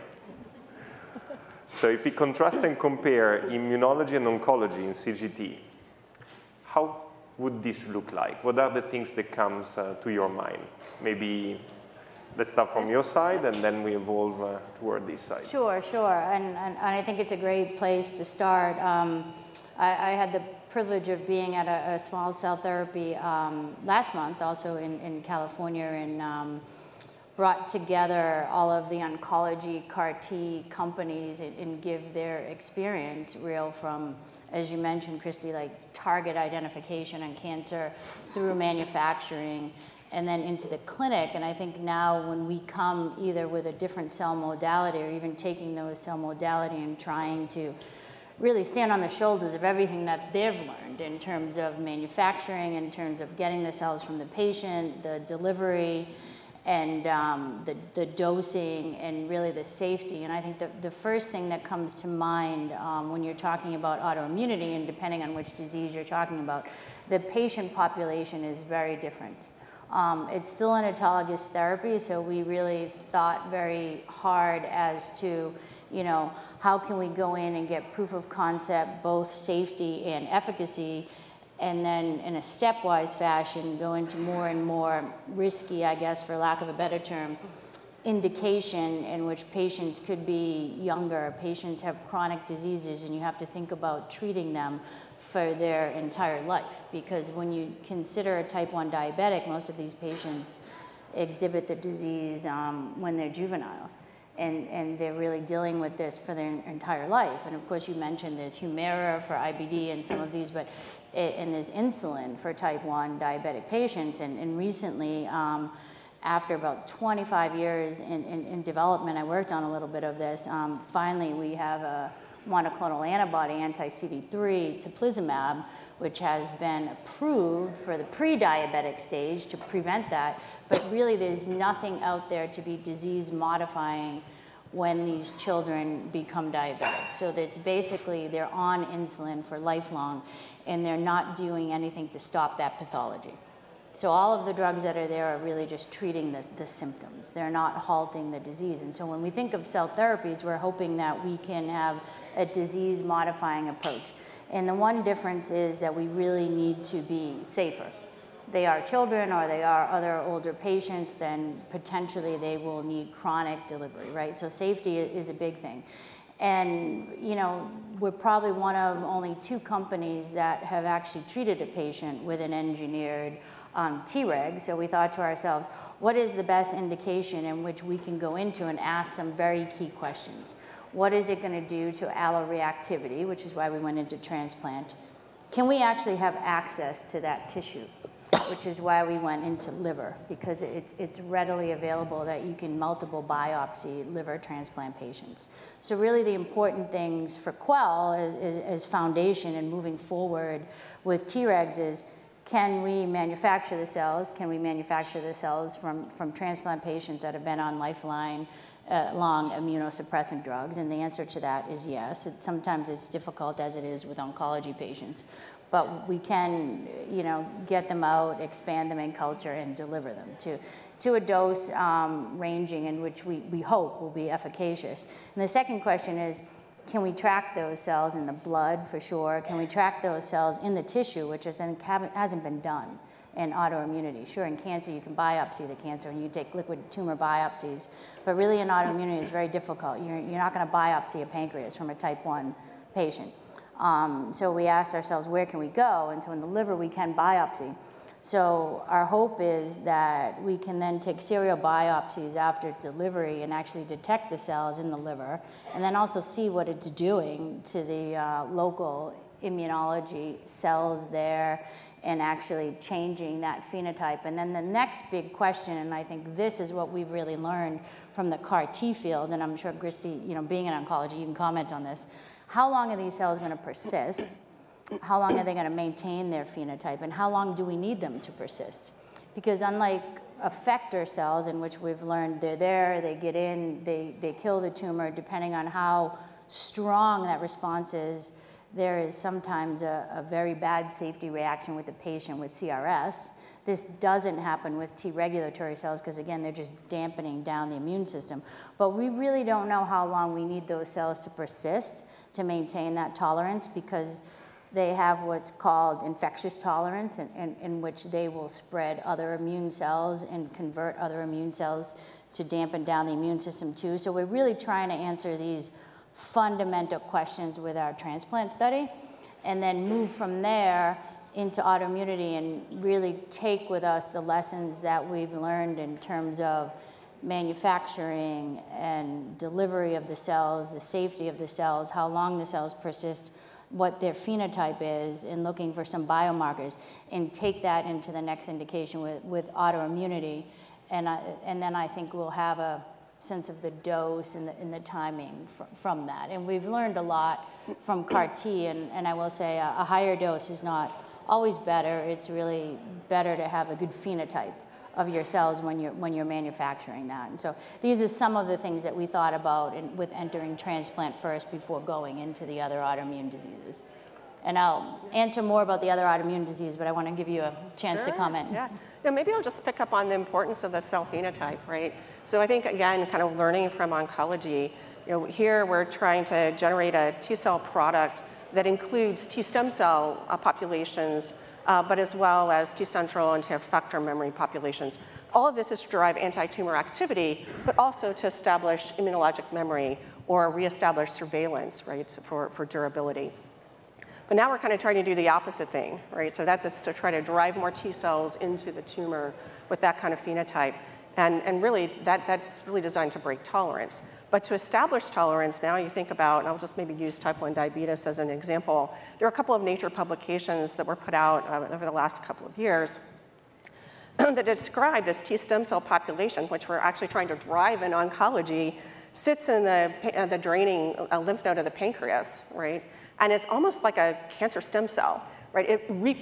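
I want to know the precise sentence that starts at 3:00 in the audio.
What is it going to do to alloreactivity, which is why we went into transplant?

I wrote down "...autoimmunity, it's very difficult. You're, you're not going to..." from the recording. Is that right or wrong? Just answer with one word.
right.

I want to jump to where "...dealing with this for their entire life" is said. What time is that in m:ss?
1:45.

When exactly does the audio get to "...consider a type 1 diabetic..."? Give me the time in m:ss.
1:37.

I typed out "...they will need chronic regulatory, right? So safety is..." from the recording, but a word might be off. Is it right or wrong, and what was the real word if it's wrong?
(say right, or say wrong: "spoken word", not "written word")
wrong: "delivery", not "regulatory".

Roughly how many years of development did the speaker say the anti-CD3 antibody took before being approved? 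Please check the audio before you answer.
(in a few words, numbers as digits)
25 years.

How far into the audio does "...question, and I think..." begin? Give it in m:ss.
4:25.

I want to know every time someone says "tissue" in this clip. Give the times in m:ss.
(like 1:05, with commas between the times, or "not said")
3:07, 3:50.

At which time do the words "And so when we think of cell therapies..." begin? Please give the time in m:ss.
2:28.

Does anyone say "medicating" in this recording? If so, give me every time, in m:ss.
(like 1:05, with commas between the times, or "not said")
not said.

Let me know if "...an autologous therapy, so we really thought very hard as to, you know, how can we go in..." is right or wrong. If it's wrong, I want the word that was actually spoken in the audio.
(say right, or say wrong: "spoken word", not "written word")
right.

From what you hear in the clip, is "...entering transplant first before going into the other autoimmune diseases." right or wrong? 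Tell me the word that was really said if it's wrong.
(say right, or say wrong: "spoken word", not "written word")
right.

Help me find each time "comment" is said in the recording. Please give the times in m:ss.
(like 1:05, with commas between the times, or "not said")
4:31, 6:08.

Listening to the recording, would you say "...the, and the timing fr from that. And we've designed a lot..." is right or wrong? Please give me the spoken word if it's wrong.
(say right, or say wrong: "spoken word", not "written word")
wrong: "learned", not "designed".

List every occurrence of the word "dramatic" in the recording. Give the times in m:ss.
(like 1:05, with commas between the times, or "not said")
not said.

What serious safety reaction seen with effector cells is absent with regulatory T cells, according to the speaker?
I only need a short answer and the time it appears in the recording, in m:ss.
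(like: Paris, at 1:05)
CRS, at 4:52.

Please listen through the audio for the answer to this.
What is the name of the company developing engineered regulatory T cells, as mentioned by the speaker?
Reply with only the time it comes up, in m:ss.
3:17.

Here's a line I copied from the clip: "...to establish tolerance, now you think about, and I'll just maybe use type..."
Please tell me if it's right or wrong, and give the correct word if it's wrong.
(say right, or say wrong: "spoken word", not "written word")
right.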